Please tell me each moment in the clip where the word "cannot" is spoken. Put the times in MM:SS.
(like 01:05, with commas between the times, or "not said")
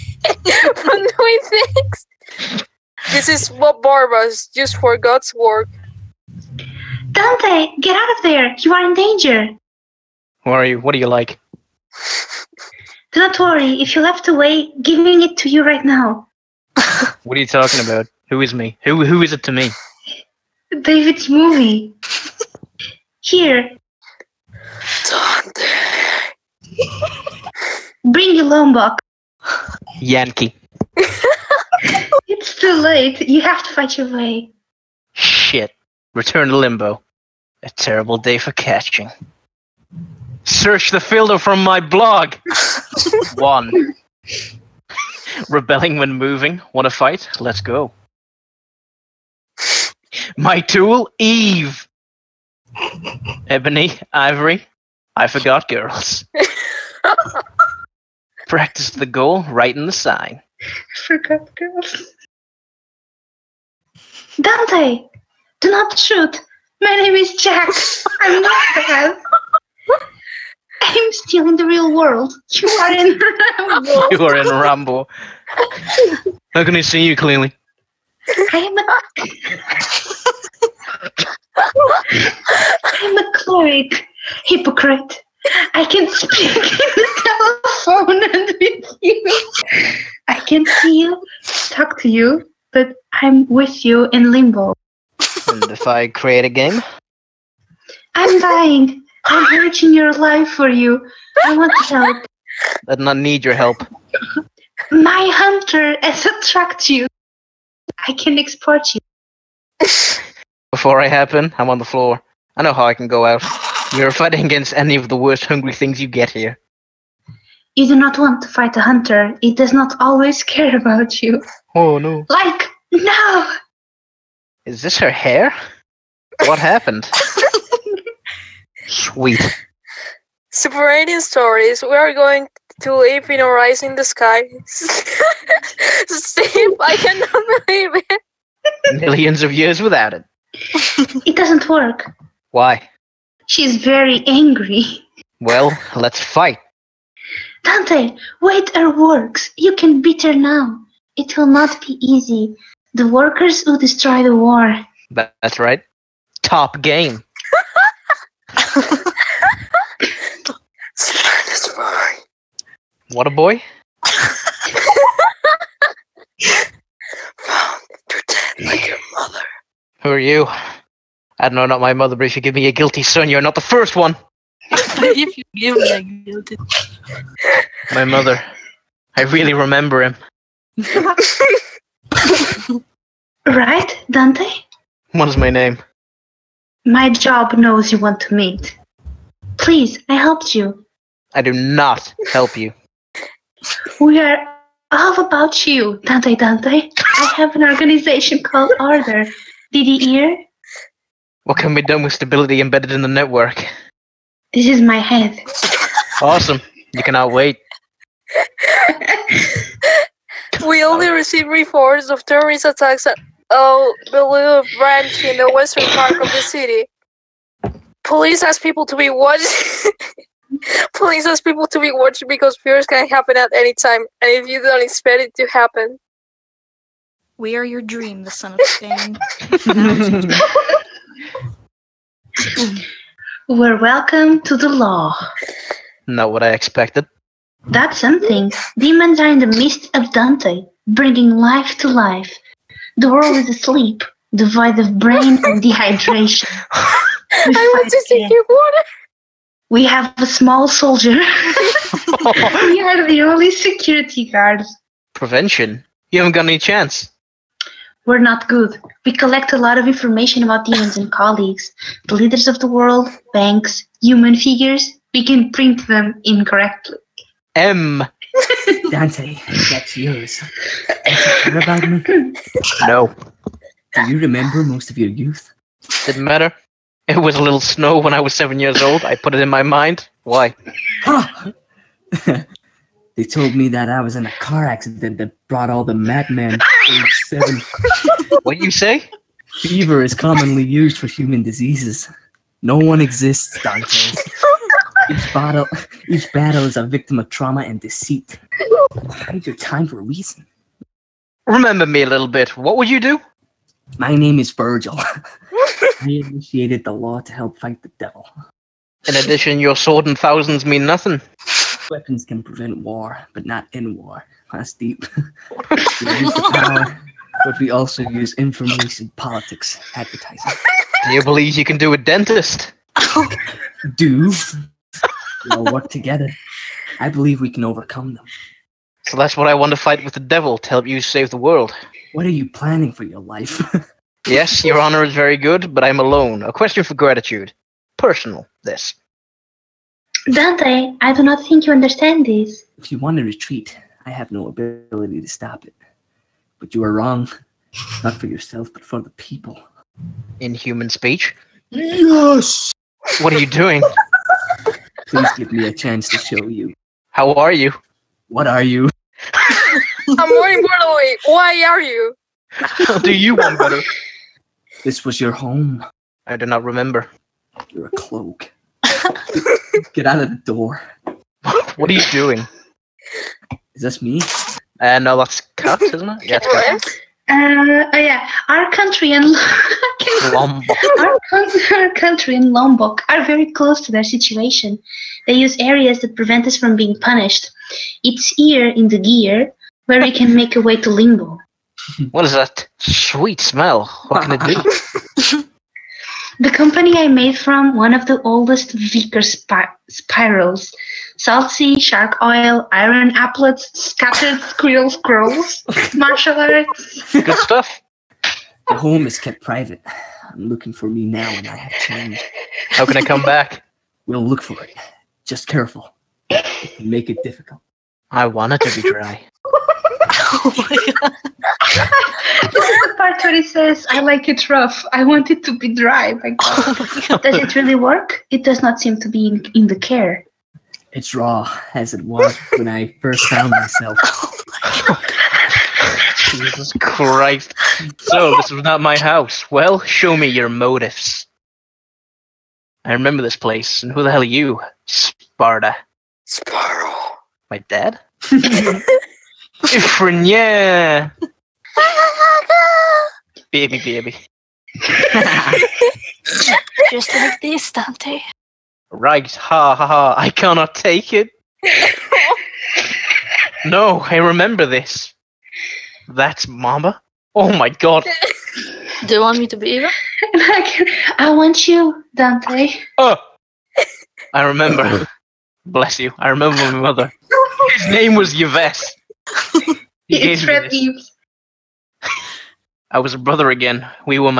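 02:16, 03:27, 07:40.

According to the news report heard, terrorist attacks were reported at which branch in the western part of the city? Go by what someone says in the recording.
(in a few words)
El Blue.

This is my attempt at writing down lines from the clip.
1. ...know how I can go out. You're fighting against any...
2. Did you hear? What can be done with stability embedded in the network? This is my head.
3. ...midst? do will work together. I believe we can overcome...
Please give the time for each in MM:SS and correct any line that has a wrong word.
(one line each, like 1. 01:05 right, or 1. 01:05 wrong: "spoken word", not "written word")
1. 01:52 right
2. 03:19 right
3. 05:21 wrong: "dentist", not "midst".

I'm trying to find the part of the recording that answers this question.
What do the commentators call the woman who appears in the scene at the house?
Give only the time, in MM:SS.
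06:15.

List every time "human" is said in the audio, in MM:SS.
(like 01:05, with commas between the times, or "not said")
04:24, 04:51, 05:50.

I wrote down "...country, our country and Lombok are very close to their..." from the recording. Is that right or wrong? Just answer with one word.
right.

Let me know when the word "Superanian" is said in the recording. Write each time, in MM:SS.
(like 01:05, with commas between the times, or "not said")
02:10.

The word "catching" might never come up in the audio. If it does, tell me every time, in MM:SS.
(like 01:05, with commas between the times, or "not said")
00:38.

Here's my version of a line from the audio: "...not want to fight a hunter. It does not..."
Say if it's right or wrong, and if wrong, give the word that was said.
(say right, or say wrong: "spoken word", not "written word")
right.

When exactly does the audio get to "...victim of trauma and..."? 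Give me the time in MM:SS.
04:56.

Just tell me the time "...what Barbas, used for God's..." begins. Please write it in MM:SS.
00:03.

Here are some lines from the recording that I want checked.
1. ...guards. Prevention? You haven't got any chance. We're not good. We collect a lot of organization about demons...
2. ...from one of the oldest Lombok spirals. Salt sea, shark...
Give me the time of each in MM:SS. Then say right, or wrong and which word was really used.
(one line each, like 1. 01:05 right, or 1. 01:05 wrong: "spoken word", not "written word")
1. 04:14 wrong: "information", not "organization"
2. 06:37 wrong: "Vickers", not "Lombok".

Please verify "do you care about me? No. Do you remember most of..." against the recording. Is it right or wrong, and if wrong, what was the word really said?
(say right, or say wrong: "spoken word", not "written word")
right.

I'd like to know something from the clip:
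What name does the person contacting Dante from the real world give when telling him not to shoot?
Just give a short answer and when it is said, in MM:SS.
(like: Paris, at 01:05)
Jack, at 01:06.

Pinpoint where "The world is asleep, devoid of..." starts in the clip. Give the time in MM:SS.
04:02.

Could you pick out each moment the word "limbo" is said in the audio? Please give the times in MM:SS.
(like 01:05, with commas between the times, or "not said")
00:36, 01:34, 06:30.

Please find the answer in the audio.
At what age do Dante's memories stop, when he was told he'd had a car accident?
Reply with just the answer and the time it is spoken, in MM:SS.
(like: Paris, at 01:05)
7, at 04:38.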